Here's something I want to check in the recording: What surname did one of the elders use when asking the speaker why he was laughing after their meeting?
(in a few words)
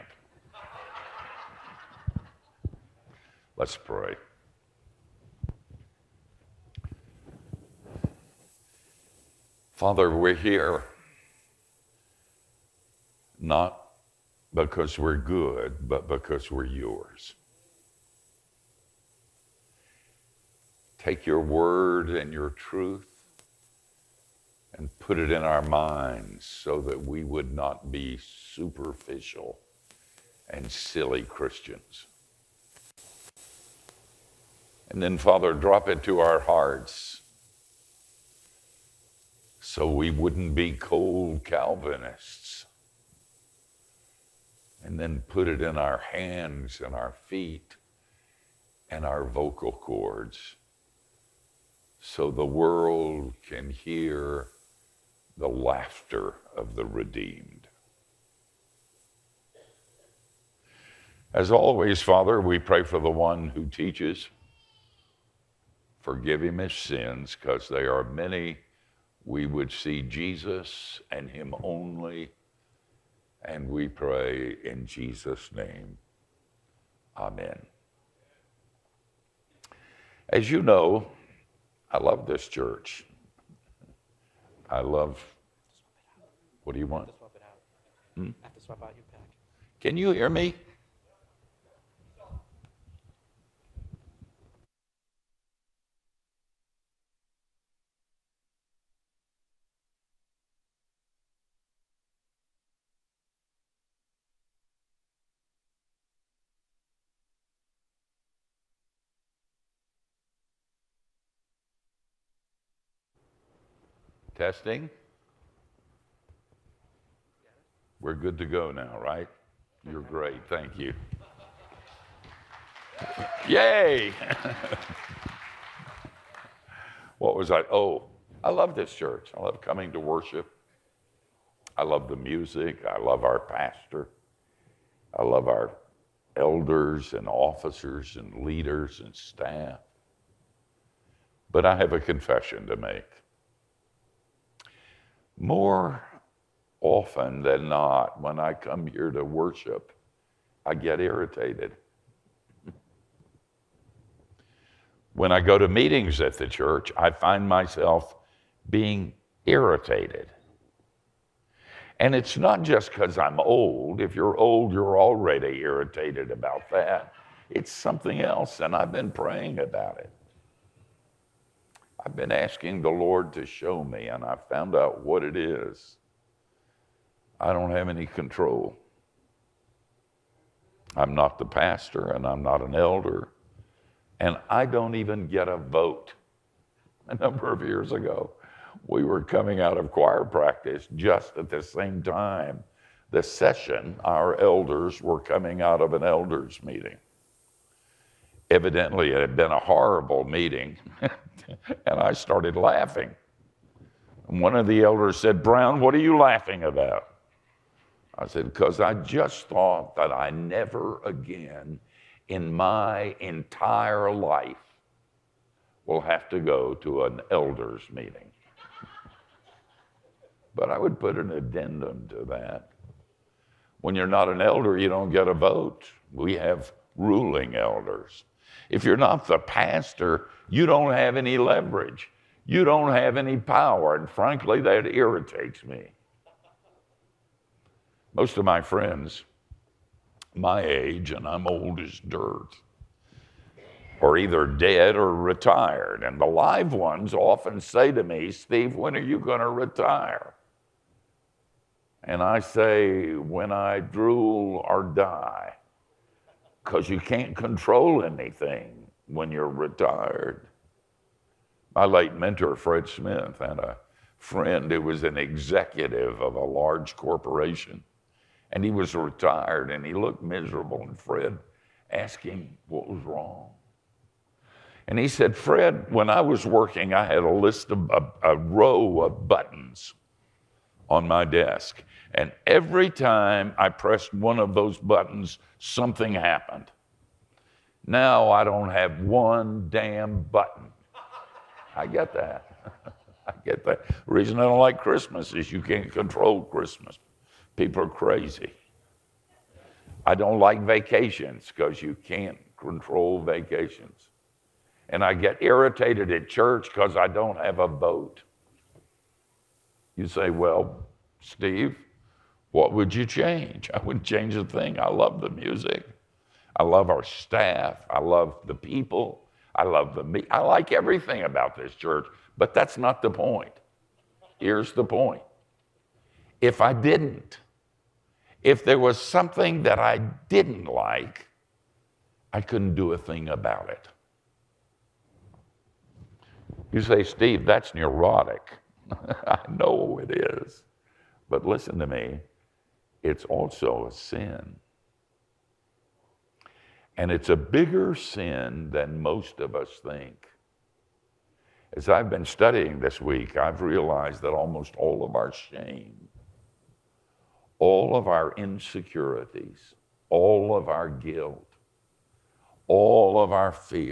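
Brown.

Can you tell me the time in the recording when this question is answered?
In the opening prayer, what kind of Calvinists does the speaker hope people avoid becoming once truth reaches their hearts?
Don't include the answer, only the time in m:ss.
0:40.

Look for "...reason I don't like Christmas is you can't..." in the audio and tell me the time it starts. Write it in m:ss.
4:54.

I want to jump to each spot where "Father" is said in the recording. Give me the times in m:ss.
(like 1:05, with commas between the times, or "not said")
0:09, 0:35, 1:02.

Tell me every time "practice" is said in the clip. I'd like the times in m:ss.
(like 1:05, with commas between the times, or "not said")
3:10.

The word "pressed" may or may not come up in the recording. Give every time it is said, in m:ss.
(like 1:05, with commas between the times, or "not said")
4:43.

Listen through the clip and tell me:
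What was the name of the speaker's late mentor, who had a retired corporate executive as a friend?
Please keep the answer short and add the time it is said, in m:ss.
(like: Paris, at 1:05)
Fred Smith, at 4:22.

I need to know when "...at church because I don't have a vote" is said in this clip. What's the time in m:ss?
5:06.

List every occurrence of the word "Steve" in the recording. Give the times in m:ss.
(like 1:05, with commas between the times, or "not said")
4:08, 5:11, 5:37.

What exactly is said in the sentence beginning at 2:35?
when I go to meetings at the church, I find myself being irritated.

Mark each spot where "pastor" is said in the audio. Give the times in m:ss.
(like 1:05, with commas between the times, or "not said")
2:13, 3:01, 3:49.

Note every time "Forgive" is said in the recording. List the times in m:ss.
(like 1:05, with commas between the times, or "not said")
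1:06.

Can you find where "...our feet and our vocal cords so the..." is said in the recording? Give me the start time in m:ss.
0:46.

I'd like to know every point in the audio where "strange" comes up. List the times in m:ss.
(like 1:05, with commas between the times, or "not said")
not said.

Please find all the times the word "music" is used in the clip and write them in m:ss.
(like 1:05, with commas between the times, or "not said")
2:12, 5:15.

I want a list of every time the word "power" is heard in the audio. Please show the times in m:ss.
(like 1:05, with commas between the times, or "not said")
3:53.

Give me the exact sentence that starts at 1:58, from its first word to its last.
We're good to go now, right?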